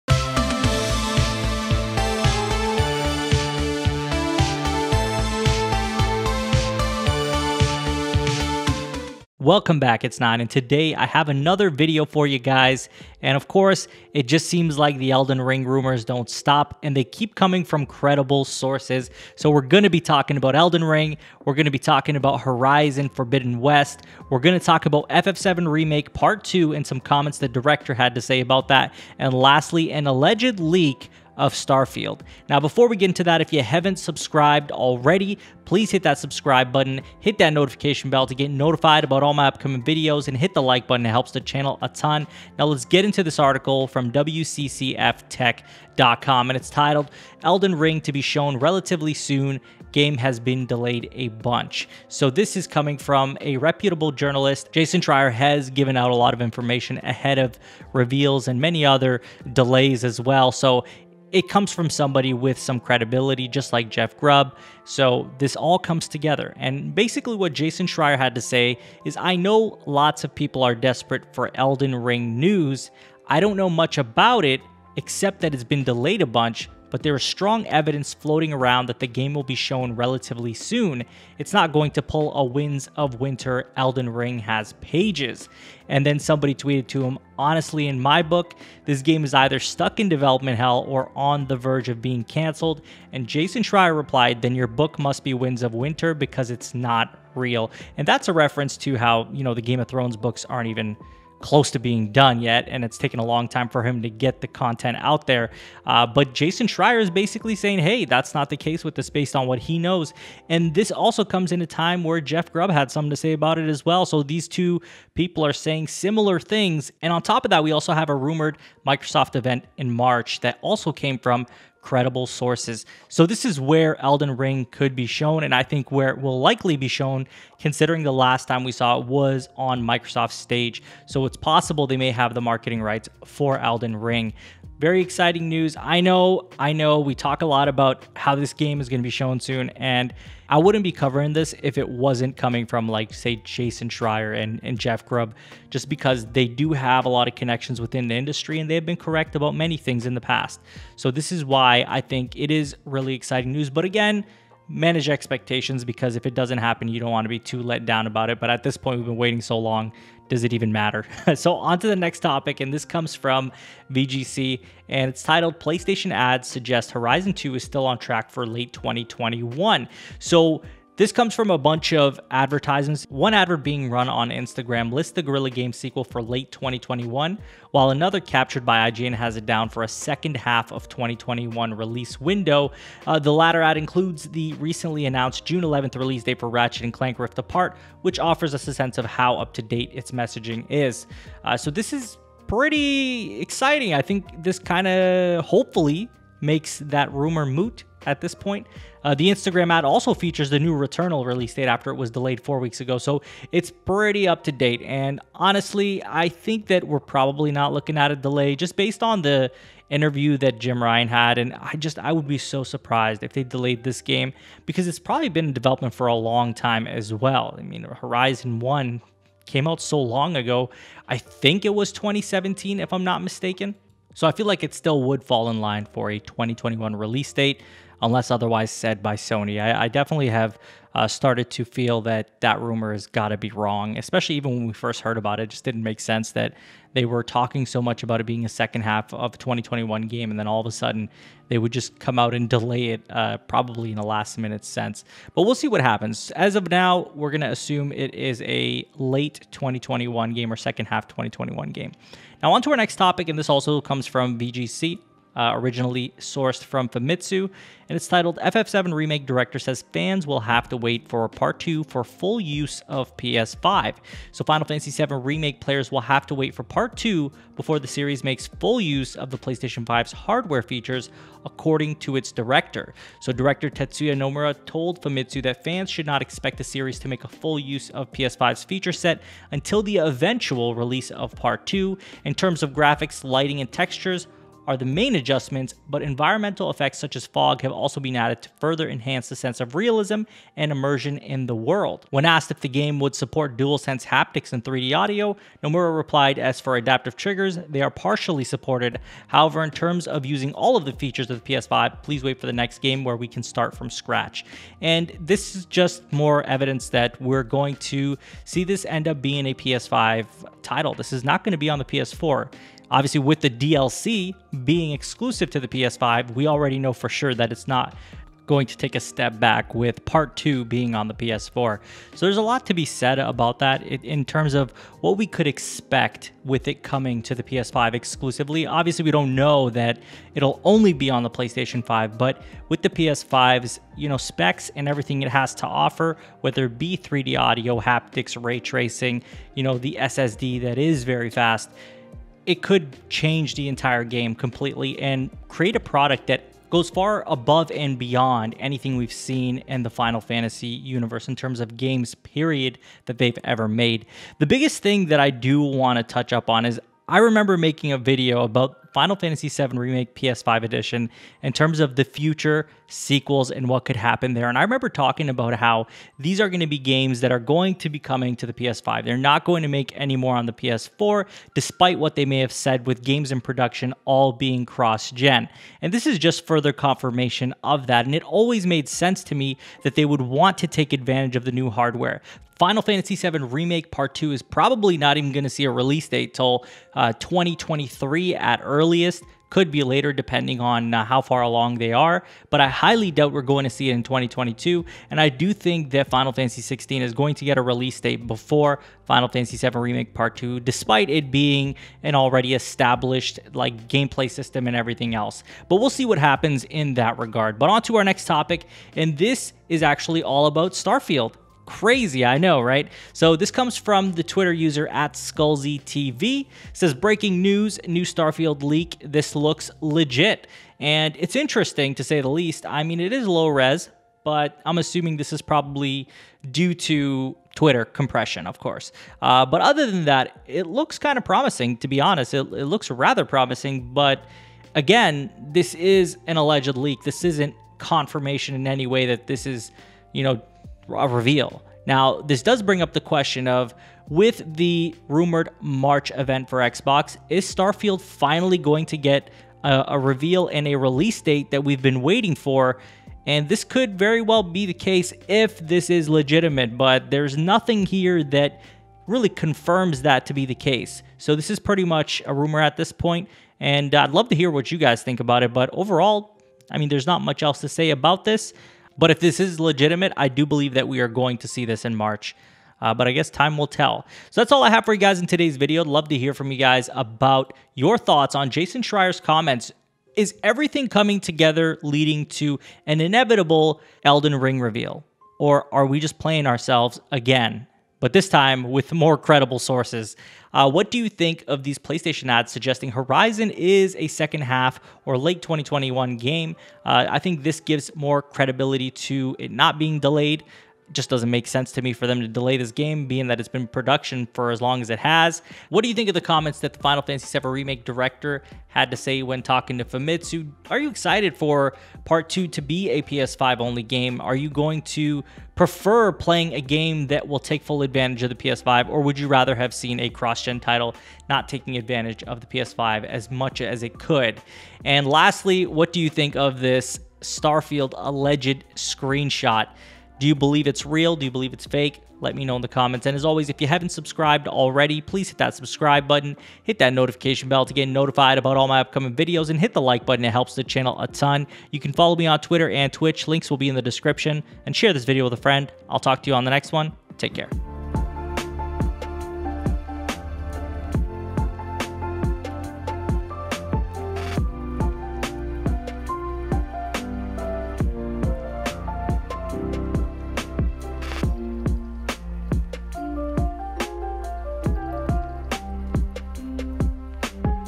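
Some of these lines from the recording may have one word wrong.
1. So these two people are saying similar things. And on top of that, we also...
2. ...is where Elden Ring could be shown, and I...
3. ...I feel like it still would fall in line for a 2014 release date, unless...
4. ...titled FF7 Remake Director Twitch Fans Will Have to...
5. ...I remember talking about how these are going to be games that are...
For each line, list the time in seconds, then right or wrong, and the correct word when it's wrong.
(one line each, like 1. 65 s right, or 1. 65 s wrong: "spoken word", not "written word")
1. 114 s right
2. 123 s right
3. 224 s wrong: "2021", not "2014"
4. 258 s wrong: "Says", not "Twitch"
5. 364 s right.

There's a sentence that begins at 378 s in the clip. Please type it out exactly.
And it always made sense to me that they would want to take advantage of the new hardware.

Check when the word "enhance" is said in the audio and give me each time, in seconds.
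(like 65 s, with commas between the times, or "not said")
288 s.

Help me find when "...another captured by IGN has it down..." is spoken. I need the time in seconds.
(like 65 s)
177 s.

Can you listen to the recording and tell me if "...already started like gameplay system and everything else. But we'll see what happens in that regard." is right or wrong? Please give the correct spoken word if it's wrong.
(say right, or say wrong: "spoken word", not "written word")
wrong: "established", not "started".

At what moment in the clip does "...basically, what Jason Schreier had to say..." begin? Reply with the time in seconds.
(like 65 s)
66 s.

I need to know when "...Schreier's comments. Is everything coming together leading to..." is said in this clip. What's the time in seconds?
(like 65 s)
478 s.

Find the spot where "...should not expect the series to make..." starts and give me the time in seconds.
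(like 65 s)
275 s.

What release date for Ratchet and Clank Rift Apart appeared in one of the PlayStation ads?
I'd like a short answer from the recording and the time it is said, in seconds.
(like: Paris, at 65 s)
June 11th, at 185 s.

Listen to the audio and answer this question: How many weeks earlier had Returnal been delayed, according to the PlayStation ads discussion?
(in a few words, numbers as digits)
4.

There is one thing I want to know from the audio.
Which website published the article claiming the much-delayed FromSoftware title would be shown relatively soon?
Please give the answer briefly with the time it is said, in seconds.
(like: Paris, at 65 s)
WCCFtech.com, at 44 s.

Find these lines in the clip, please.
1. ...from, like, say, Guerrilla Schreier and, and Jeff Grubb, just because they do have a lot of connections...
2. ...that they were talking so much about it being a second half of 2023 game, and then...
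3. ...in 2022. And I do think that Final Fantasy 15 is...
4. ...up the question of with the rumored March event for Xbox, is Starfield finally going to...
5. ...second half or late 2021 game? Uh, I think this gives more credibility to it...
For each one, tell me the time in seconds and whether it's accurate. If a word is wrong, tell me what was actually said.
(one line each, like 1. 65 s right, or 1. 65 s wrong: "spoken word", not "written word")
1. 142 s wrong: "Jason", not "Guerrilla"
2. 236 s wrong: "2021", not "2023"
3. 393 s wrong: "16", not "15"
4. 442 s right
5. 494 s right.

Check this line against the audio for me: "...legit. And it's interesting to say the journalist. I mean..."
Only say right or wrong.
wrong.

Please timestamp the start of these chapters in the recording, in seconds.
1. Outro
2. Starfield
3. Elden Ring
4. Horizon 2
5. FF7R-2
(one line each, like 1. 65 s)
1. 473 s
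2. 408 s
3. 44 s
4. 162 s
5. 253 s.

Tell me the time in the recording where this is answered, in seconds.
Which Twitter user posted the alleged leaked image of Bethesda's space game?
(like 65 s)
415 s.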